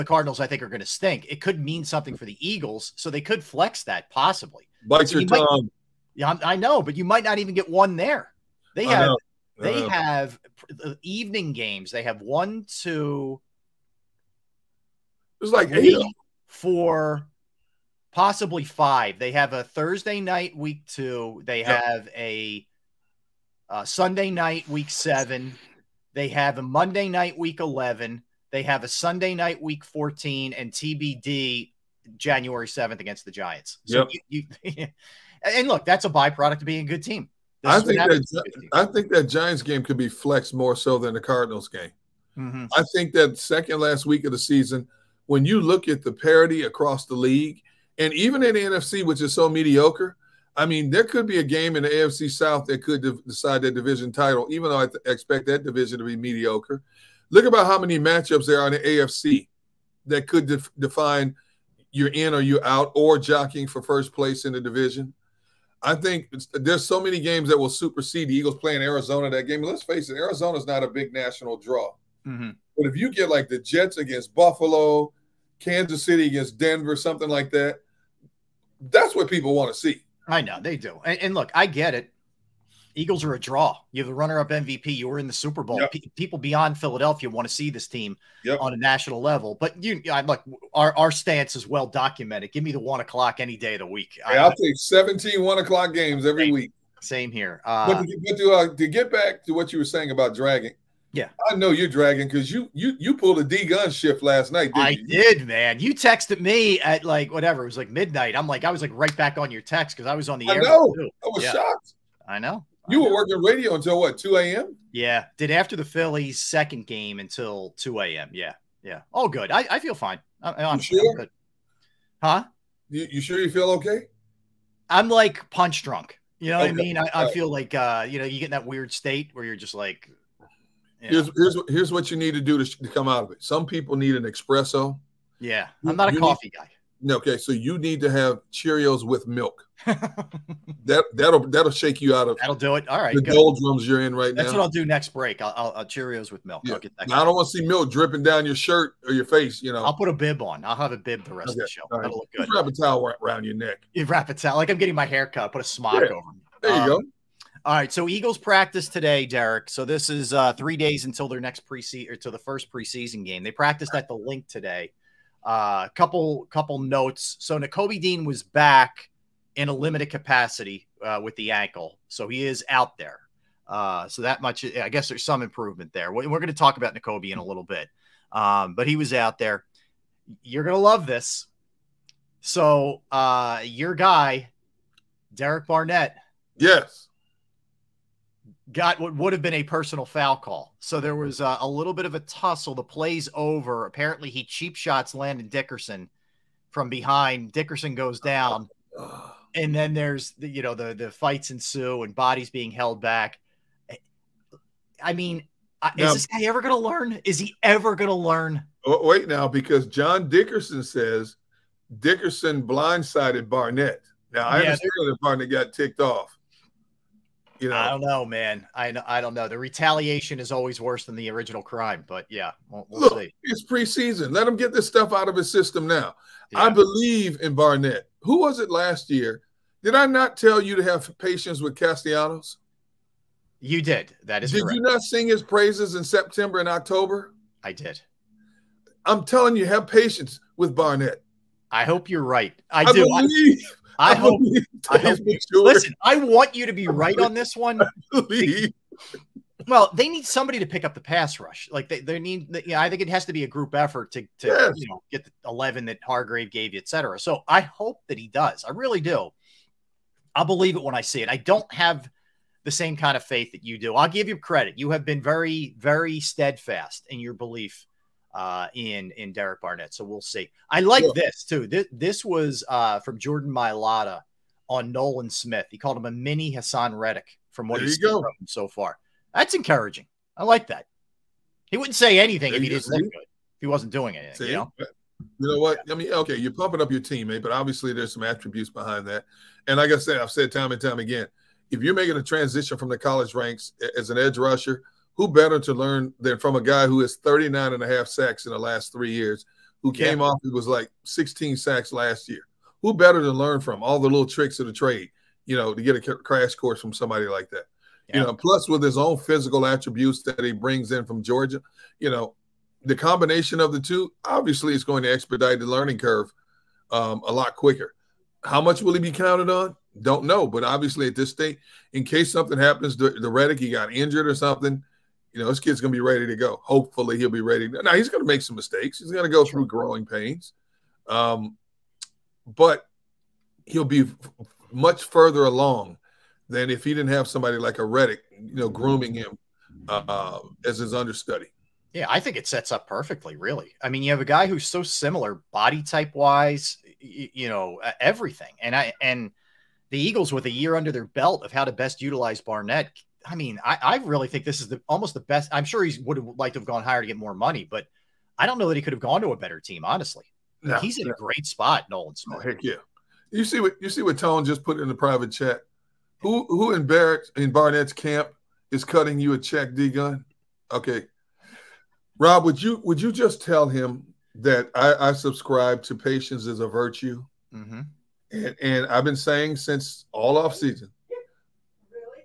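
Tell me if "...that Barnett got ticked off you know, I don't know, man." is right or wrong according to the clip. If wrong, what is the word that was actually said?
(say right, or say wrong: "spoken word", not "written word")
right.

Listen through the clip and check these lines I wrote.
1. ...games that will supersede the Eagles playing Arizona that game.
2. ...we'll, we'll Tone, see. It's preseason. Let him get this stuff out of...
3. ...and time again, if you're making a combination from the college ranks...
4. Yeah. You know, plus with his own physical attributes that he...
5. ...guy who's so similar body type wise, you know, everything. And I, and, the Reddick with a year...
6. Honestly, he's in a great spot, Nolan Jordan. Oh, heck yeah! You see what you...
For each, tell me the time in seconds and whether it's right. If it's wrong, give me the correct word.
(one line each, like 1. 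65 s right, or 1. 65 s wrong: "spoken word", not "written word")
1. 67 s right
2. 222 s wrong: "Look", not "Tone"
3. 290 s wrong: "transition", not "combination"
4. 308 s right
5. 344 s wrong: "Eagles", not "Reddick"
6. 359 s wrong: "Smith", not "Jordan".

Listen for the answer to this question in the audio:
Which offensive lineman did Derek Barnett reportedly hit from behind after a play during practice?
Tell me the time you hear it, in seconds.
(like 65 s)
195 s.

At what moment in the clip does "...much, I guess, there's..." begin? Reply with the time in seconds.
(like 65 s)
174 s.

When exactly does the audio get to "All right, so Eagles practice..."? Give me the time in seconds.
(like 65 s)
157 s.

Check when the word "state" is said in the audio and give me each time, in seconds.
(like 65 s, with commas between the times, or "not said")
128 s, 321 s.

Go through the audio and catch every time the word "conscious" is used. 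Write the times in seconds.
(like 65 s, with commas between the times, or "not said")
not said.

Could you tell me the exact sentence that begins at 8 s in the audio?
They have they have evening games.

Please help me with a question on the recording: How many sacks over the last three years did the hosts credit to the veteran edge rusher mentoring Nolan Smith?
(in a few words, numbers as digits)
39.5.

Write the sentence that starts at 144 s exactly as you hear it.
That's what I'll do next break.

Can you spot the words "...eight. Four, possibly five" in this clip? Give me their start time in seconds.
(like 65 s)
15 s.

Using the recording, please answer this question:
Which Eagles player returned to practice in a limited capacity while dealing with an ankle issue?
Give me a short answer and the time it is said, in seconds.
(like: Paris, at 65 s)
N'Kobe Dean, at 167 s.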